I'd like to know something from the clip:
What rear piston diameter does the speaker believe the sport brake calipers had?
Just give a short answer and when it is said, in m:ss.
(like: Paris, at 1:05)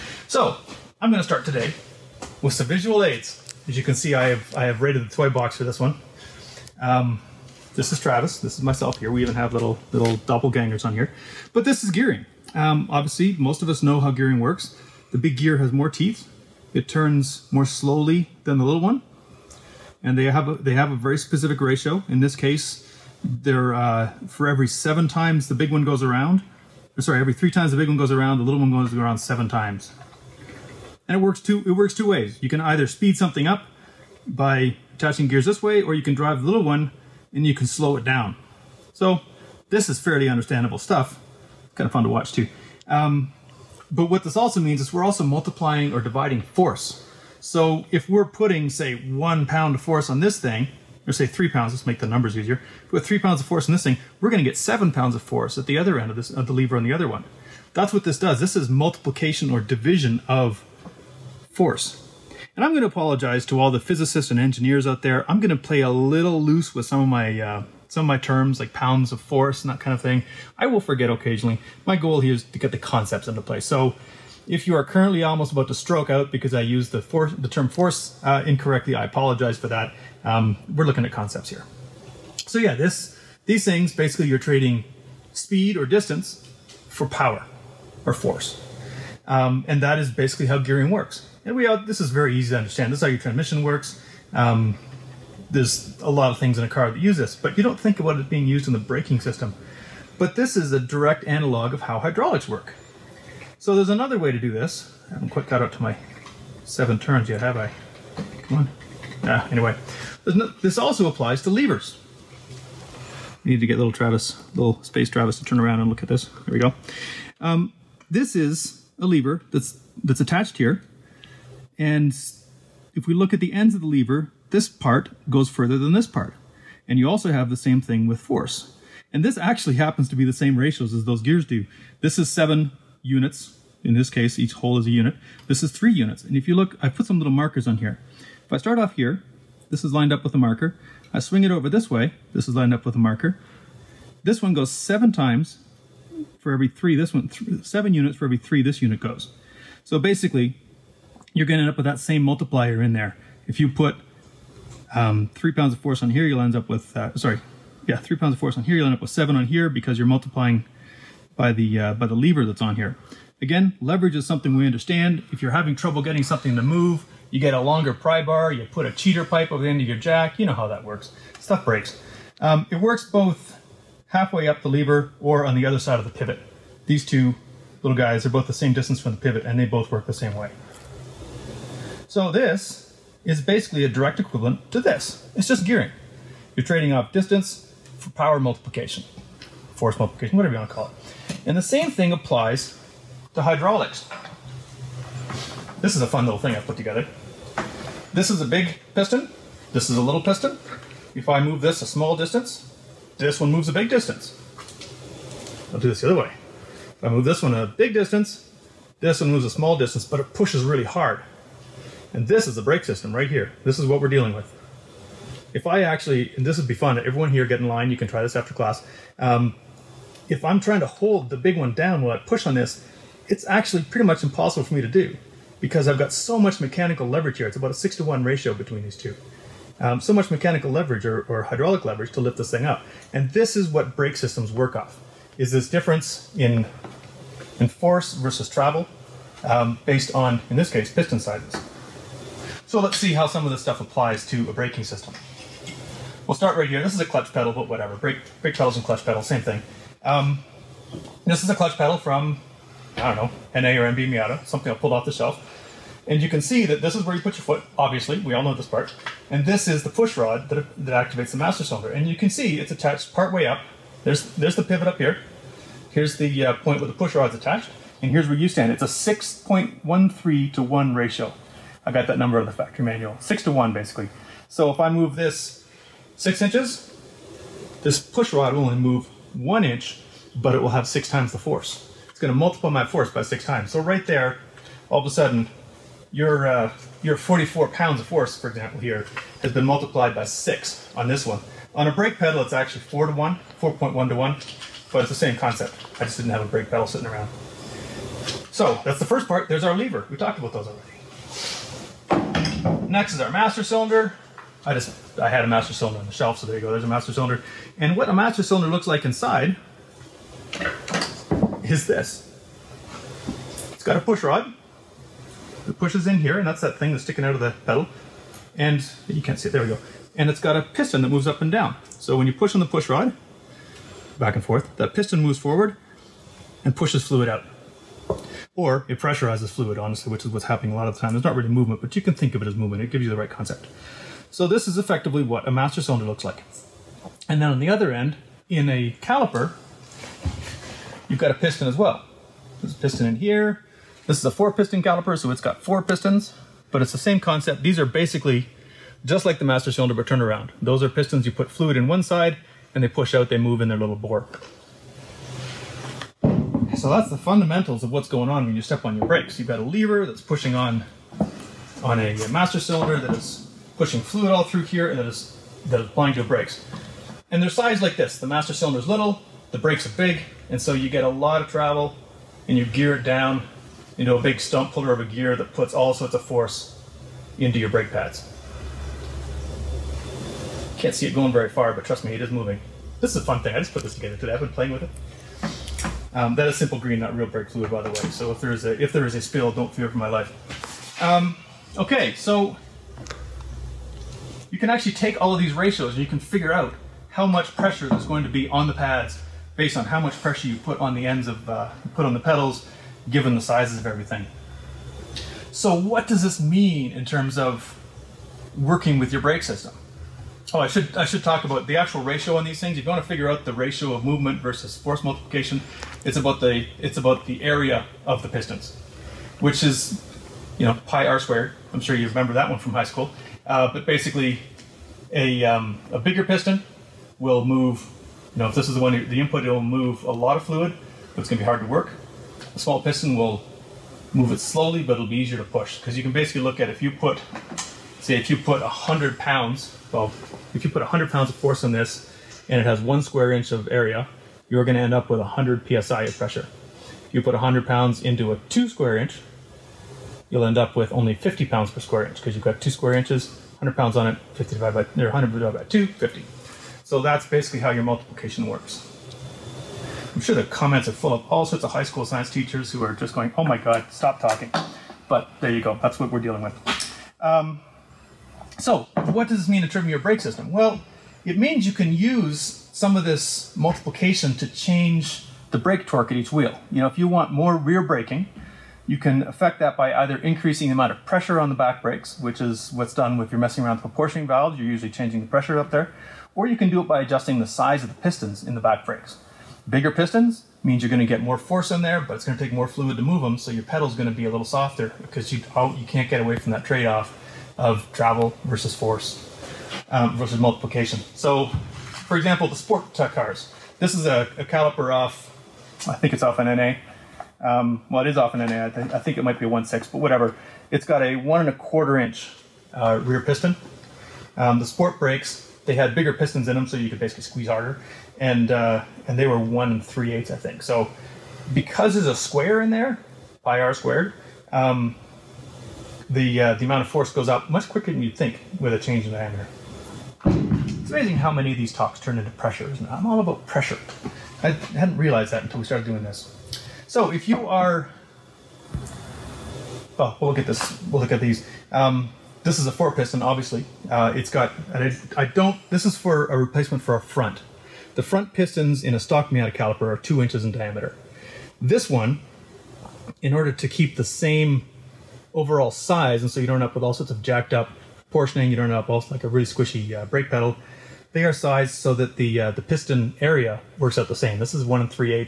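1 3/8 inch, at 8:39.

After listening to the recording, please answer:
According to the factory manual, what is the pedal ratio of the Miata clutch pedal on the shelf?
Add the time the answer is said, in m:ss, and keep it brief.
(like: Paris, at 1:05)
6.13 to 1, at 4:28.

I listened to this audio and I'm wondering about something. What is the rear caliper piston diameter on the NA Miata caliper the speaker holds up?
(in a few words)
1 1/4 inch.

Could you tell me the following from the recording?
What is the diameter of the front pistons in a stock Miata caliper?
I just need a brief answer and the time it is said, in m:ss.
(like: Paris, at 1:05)
2 inches, at 9:09.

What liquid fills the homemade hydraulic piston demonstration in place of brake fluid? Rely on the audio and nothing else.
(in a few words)
Simple Green.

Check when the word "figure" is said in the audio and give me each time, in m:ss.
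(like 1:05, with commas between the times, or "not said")
6:36, 6:53.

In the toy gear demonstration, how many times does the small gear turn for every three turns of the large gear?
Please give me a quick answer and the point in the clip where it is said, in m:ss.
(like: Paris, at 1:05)
7, at 0:28.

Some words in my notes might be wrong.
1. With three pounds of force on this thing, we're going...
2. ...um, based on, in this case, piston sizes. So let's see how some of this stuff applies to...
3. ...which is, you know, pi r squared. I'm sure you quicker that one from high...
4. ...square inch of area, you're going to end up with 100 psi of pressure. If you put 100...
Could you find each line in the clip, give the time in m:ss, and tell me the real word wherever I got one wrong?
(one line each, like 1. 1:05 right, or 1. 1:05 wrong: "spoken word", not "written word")
1. 0:52 right
2. 3:59 right
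3. 6:59 wrong: "remember", not "quicker"
4. 7:23 right.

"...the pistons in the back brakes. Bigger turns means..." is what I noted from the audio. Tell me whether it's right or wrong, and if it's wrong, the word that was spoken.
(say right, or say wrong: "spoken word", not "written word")
wrong: "pistons", not "turns".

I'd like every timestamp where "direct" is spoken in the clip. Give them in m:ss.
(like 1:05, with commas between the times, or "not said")
1:40, 3:03.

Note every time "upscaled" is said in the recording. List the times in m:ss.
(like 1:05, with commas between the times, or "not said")
not said.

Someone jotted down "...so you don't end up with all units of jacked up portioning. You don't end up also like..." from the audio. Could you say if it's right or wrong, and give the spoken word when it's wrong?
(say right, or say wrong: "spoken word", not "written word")
wrong: "sorts", not "units".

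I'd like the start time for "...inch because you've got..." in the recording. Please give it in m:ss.
7:32.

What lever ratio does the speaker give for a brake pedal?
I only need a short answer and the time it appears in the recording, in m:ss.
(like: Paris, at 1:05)
4.1 to 1, at 4:53.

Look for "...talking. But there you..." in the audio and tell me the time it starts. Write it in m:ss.
7:44.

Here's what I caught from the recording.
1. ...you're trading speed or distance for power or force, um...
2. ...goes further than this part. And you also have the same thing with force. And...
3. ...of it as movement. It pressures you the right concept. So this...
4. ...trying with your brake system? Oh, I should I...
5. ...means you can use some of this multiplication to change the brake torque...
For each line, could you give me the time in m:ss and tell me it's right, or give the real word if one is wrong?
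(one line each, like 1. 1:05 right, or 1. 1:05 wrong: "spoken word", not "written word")
1. 1:24 right
2. 2:05 right
3. 5:32 wrong: "gives", not "pressures"
4. 6:48 wrong: "working", not "trying"
5. 7:51 right.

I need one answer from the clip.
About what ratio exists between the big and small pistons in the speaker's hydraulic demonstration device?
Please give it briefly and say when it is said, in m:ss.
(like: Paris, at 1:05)
6 to 1, at 3:47.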